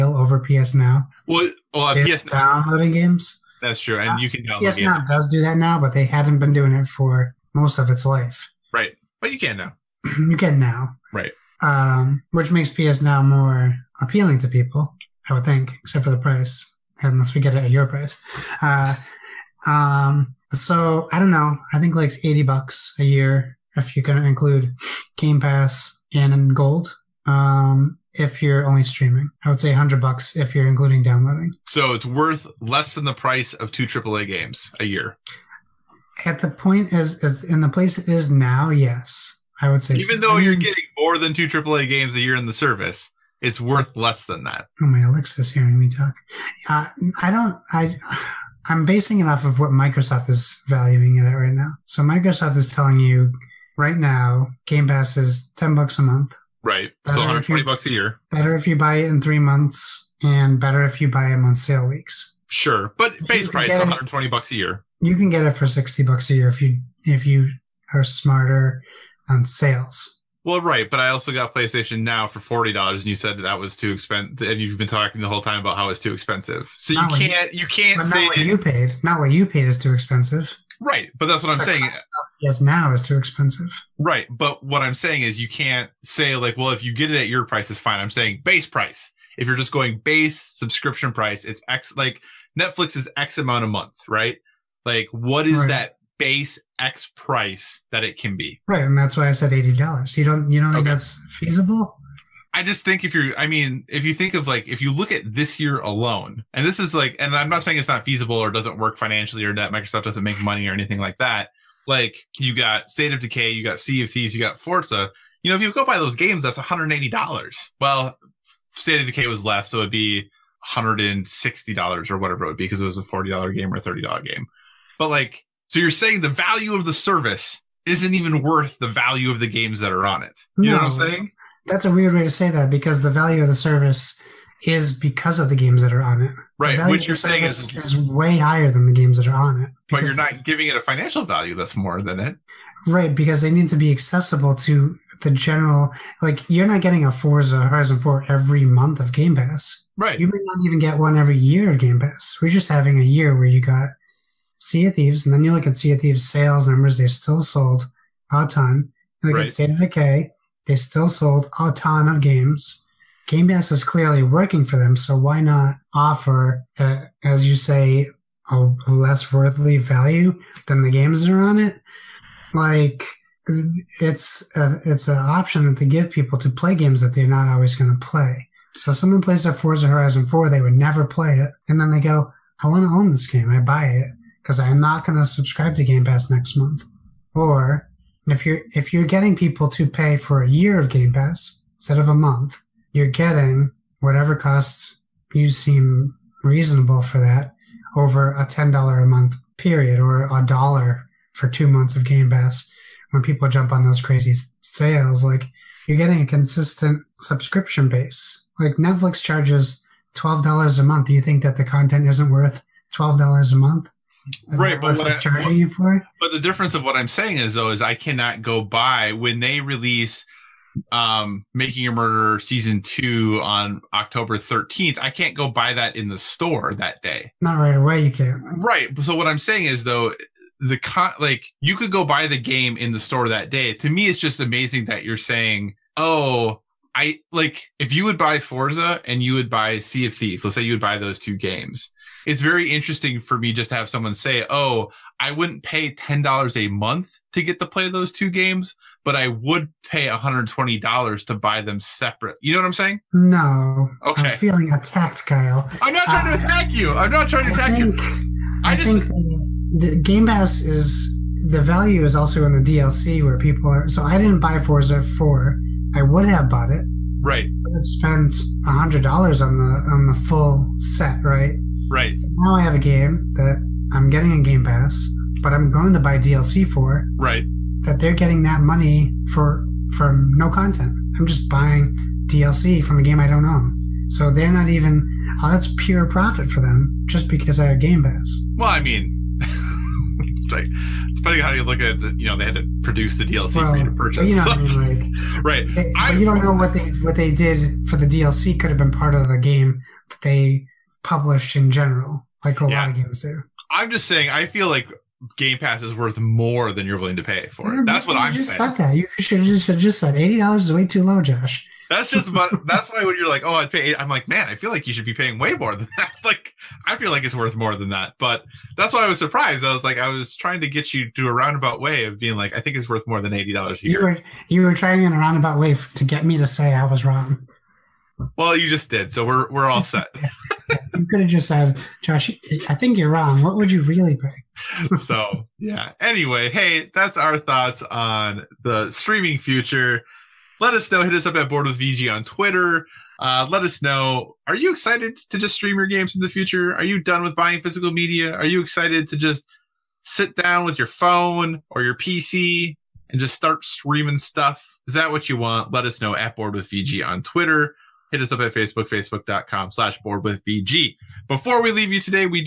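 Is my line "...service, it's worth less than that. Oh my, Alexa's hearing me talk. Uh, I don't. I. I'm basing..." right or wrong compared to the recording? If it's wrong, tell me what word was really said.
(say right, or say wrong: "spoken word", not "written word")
right.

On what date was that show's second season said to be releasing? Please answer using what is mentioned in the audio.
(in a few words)
October 13th.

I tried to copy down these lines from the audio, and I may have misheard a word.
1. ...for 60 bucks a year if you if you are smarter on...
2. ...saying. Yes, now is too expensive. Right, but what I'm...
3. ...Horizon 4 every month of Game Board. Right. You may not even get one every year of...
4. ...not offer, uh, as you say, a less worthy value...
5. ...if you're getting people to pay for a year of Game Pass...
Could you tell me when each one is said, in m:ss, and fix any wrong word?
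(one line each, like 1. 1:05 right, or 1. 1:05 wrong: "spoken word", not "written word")
1. 1:05 right
2. 1:21 right
3. 2:27 wrong: "Pass", not "Board"
4. 2:45 right
5. 3:08 right.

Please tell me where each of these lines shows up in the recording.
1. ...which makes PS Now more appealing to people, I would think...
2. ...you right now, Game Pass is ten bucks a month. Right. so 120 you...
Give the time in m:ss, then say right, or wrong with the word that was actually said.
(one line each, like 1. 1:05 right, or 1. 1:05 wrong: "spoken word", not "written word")
1. 0:12 right
2. 0:52 right.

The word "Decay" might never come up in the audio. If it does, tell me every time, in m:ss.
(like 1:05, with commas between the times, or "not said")
1:53, 1:59, 2:39.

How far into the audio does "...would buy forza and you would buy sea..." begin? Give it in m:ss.
3:58.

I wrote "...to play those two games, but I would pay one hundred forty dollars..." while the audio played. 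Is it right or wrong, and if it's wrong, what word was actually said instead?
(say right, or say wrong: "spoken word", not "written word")
wrong: "twenty", not "forty".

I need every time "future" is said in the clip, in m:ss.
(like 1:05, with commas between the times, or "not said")
5:39, 5:46.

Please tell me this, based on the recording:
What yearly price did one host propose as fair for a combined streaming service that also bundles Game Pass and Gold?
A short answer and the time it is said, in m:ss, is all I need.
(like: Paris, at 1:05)
80 bucks, at 0:22.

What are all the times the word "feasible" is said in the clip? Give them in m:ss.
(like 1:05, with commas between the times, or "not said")
1:41, 1:48.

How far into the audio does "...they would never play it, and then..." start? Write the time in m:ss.
3:00.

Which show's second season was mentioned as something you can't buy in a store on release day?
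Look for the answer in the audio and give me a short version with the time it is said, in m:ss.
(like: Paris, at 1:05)
Making a Murderer, at 3:41.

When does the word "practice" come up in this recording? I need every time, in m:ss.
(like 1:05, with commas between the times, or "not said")
not said.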